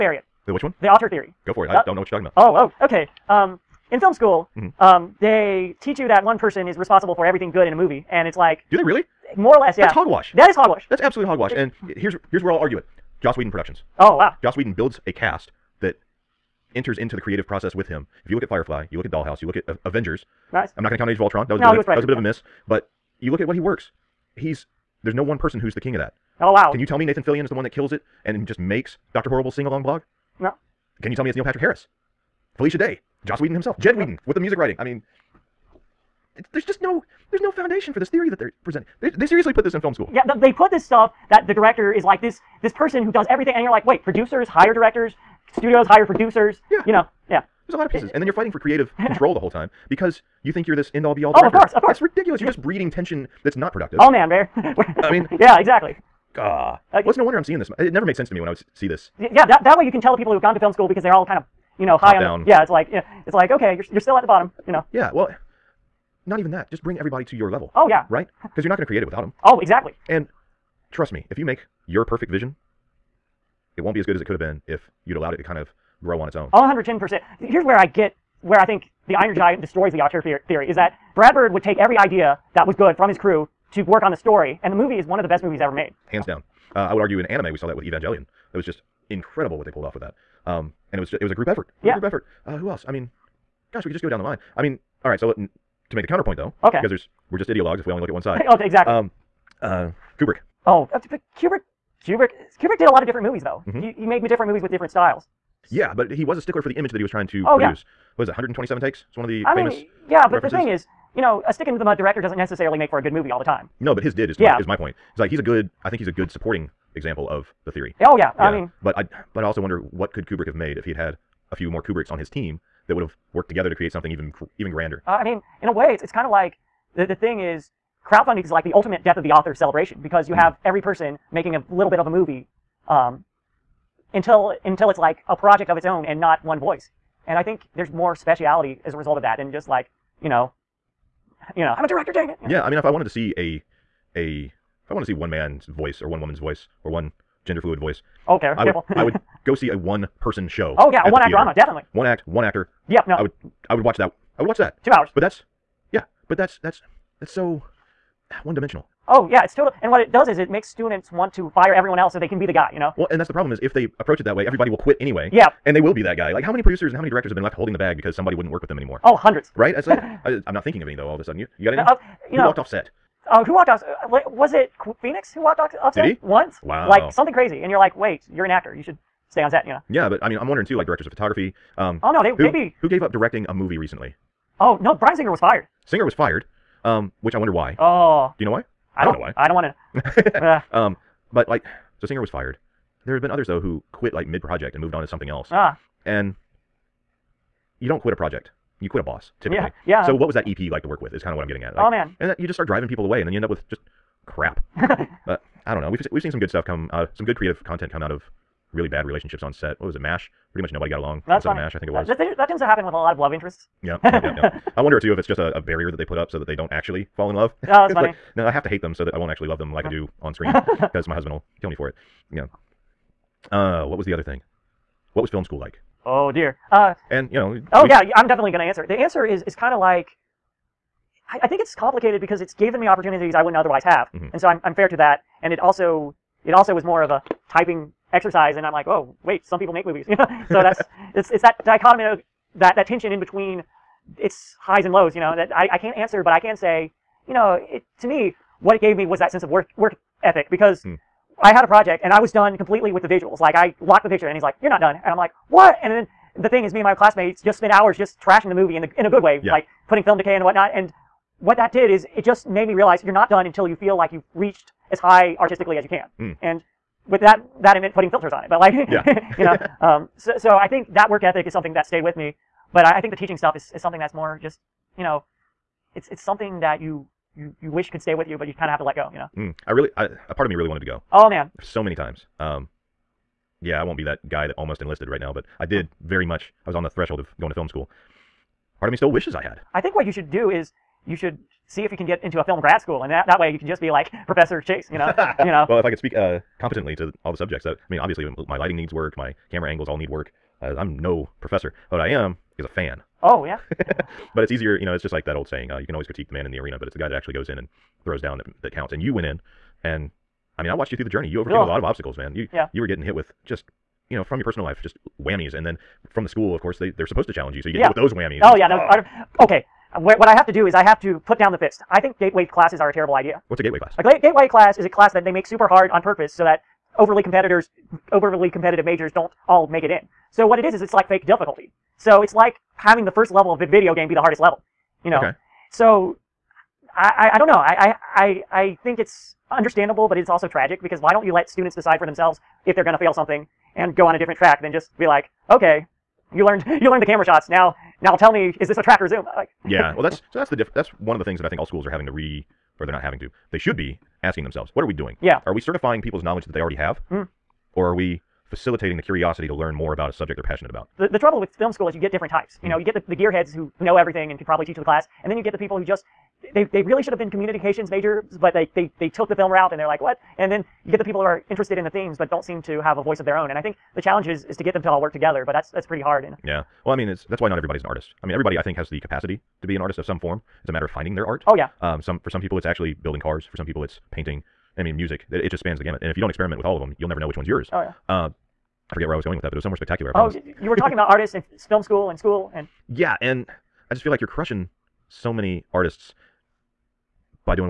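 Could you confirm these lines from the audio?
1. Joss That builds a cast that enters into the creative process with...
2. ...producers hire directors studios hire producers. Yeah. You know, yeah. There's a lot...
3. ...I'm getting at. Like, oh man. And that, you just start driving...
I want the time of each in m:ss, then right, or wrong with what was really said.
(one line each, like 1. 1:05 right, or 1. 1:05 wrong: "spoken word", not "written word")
1. 0:14 wrong: "Whedon", not "That"
2. 0:44 right
3. 3:21 right.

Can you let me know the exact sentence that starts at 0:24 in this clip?
He's there's no one person who's the king of that.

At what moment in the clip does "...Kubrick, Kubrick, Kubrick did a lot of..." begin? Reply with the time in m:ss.
1:41.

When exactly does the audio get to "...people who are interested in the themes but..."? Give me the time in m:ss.
6:11.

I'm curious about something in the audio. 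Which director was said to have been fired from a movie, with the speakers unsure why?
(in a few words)
Bryan Singer.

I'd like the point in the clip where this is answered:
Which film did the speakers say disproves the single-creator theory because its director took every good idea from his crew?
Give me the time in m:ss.
1:19.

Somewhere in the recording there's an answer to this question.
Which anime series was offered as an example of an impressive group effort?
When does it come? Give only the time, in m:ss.
1:27.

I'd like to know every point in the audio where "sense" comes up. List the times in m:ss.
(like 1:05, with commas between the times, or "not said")
0:58, 4:09.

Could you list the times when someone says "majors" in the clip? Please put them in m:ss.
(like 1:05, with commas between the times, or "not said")
5:28, 6:07.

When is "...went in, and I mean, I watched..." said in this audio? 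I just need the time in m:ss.
5:09.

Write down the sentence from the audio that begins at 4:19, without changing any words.
like putting film decay and whatnot.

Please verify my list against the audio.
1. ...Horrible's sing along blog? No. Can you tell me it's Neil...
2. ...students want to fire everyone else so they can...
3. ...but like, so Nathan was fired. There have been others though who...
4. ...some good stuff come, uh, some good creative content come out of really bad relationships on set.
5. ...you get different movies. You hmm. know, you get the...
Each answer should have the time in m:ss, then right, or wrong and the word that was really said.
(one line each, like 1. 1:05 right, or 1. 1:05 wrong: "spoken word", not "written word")
1. 0:29 right
2. 2:40 right
3. 3:11 wrong: "Singer", not "Nathan"
4. 3:26 right
5. 6:01 wrong: "types", not "movies".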